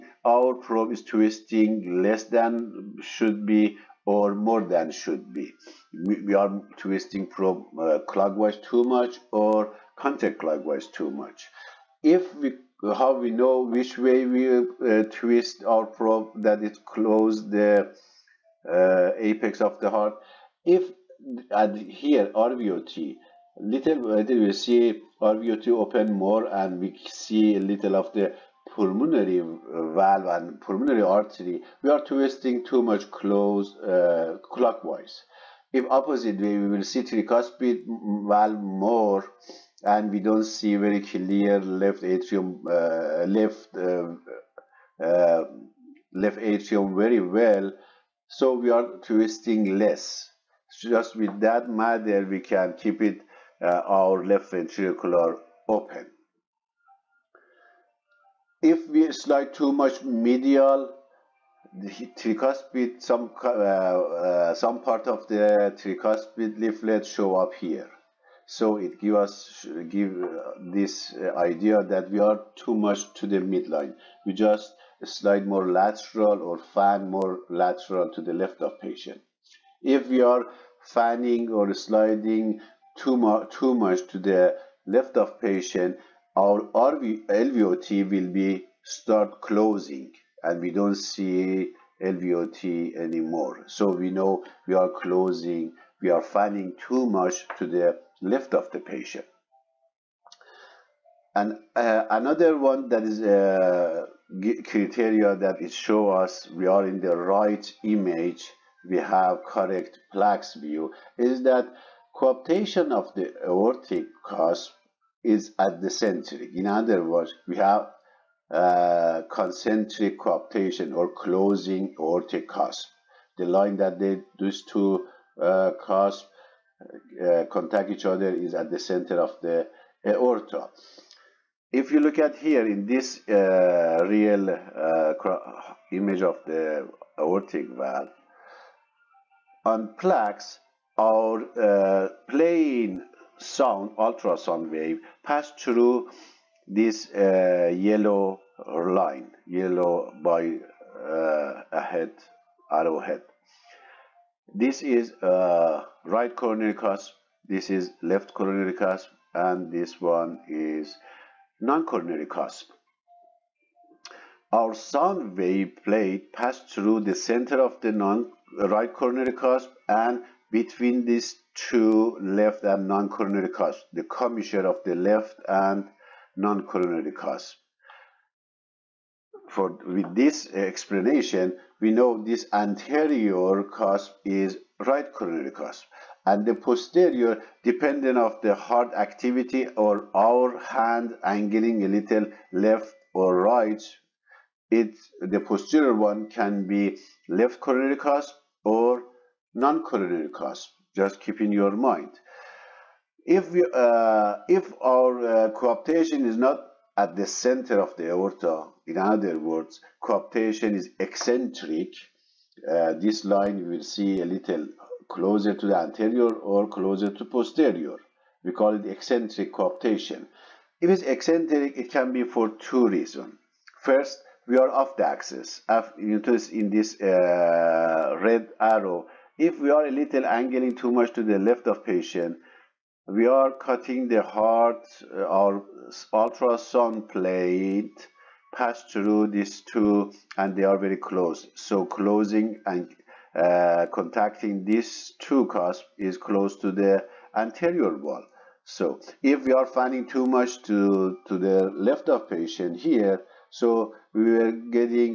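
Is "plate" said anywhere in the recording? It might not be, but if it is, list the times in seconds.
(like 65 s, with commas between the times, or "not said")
165 s, 237 s.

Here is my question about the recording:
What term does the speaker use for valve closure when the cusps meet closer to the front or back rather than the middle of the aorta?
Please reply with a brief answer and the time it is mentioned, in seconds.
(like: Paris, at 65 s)
Eccentric coaptation, at 218 s.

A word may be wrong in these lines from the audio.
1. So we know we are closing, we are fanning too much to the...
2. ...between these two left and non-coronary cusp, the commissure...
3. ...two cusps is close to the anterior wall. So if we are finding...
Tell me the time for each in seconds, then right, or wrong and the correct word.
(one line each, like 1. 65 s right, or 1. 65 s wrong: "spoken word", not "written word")
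1. 93 s right
2. 170 s right
3. 245 s right.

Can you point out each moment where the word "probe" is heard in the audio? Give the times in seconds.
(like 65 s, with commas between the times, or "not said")
0 s, 7 s, 15 s.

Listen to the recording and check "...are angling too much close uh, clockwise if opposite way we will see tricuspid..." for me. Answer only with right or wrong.
wrong.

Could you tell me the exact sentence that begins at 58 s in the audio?
If we slide too much medial, the tricuspid, some, uh, uh, some part of the tricuspid leaflet show up here.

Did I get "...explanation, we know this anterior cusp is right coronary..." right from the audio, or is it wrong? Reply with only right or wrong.
right.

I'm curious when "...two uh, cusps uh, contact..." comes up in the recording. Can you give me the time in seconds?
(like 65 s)
124 s.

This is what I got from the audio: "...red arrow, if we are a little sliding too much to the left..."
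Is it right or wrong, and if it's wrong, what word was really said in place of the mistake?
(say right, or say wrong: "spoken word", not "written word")
wrong: "angling", not "sliding".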